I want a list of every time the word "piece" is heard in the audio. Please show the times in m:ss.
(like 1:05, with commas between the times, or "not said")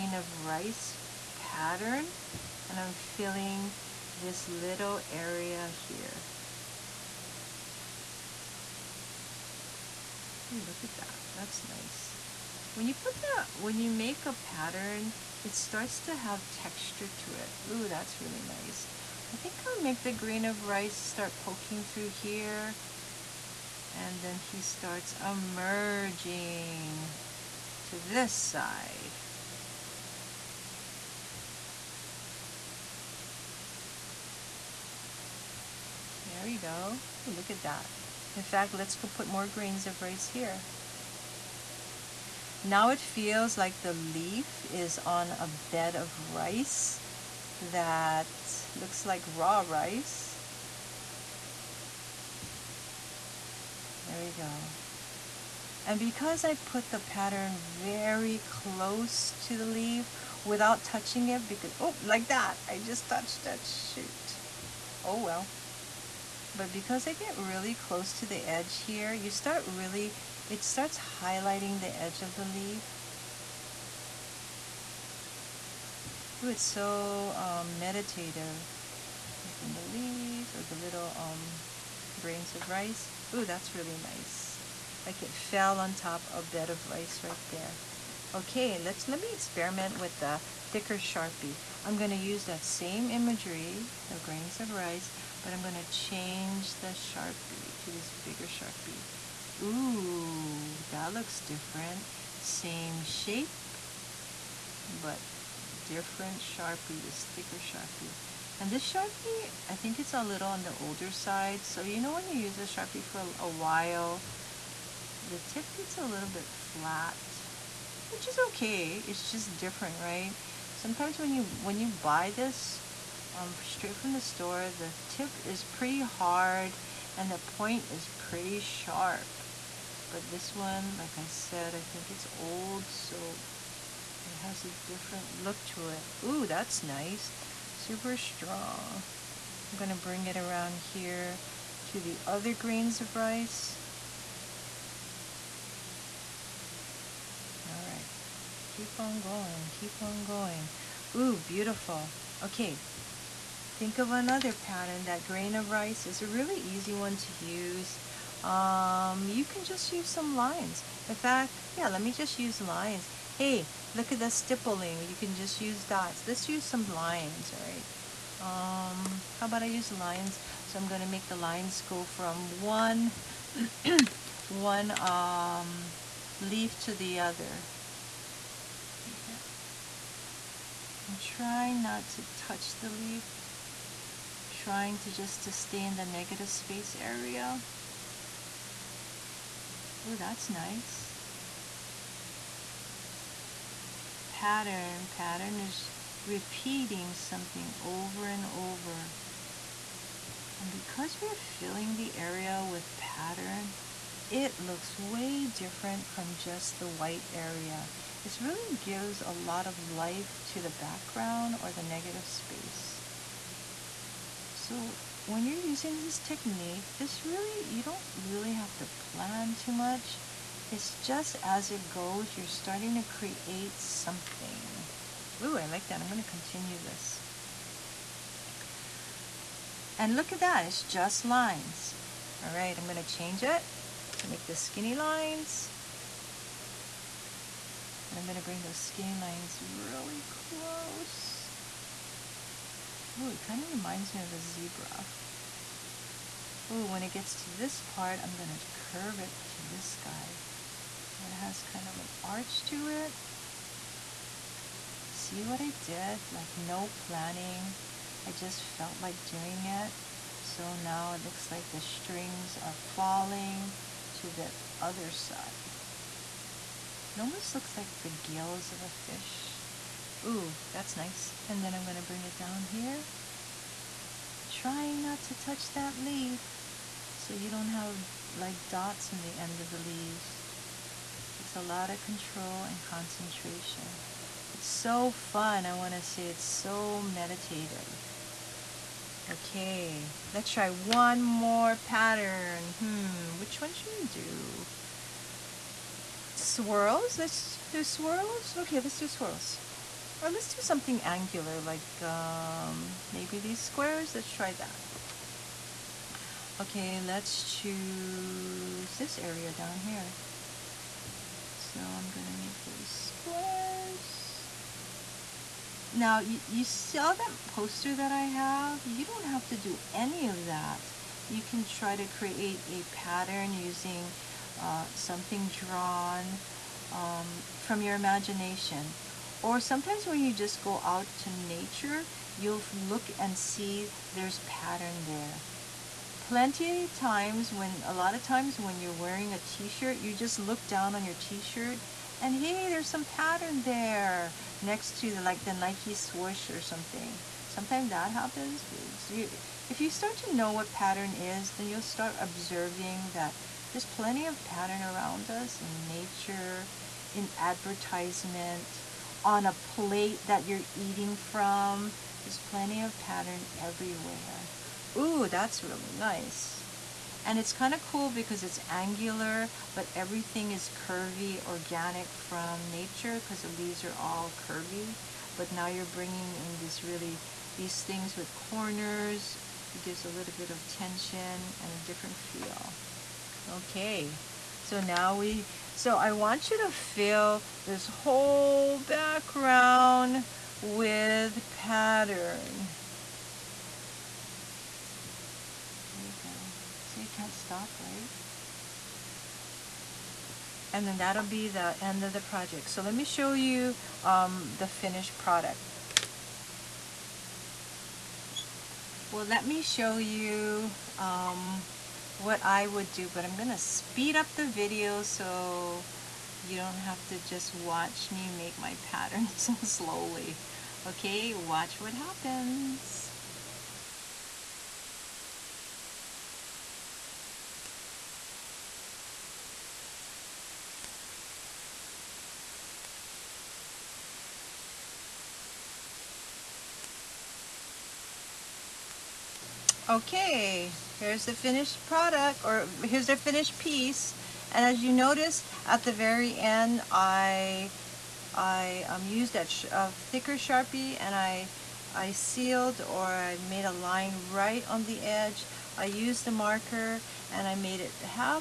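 7:23.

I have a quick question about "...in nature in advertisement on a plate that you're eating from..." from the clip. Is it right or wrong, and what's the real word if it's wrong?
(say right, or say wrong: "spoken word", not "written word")
right.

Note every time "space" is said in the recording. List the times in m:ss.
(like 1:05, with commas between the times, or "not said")
3:06, 3:32.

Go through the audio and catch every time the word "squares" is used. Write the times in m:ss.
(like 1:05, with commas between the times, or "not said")
5:03, 5:13.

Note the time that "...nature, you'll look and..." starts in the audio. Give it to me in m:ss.
5:31.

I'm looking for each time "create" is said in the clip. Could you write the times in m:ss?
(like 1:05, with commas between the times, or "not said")
3:43, 5:22.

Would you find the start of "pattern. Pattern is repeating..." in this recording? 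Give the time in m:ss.
3:14.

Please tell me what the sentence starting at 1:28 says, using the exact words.
Okay, let's let me experiment with the thicker Sharpie.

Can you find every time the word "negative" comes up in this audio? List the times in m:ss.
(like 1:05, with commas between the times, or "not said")
3:06, 3:31.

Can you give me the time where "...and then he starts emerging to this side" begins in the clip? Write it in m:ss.
0:23.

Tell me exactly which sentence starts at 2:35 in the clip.
That grain of rice is a really easy one to use.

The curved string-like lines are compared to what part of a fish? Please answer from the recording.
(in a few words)
Gills.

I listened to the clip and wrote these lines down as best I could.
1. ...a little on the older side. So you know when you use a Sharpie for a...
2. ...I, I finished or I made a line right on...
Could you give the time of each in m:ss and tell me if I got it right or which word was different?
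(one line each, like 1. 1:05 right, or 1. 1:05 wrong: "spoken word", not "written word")
1. 1:50 right
2. 7:31 wrong: "sealed", not "finished".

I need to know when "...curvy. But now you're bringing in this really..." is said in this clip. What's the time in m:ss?
6:14.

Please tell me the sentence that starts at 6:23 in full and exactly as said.
Okay, so now we, so I want you to fill this whole background with pattern.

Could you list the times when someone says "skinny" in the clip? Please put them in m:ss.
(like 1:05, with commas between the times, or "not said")
3:54, 3:58.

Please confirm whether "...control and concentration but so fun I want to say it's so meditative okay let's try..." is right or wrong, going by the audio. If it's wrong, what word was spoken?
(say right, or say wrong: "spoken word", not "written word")
right.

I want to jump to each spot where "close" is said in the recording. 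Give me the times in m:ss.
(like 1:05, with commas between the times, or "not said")
0:58, 1:07, 4:00.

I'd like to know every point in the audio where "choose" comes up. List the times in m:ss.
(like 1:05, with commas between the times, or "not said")
5:07.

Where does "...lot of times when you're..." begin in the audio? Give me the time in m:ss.
5:37.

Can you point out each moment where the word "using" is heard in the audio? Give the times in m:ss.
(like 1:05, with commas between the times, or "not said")
3:35, 5:23.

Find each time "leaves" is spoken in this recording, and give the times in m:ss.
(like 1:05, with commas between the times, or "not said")
1:19, 4:39, 6:13.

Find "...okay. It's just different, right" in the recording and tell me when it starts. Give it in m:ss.
1:58.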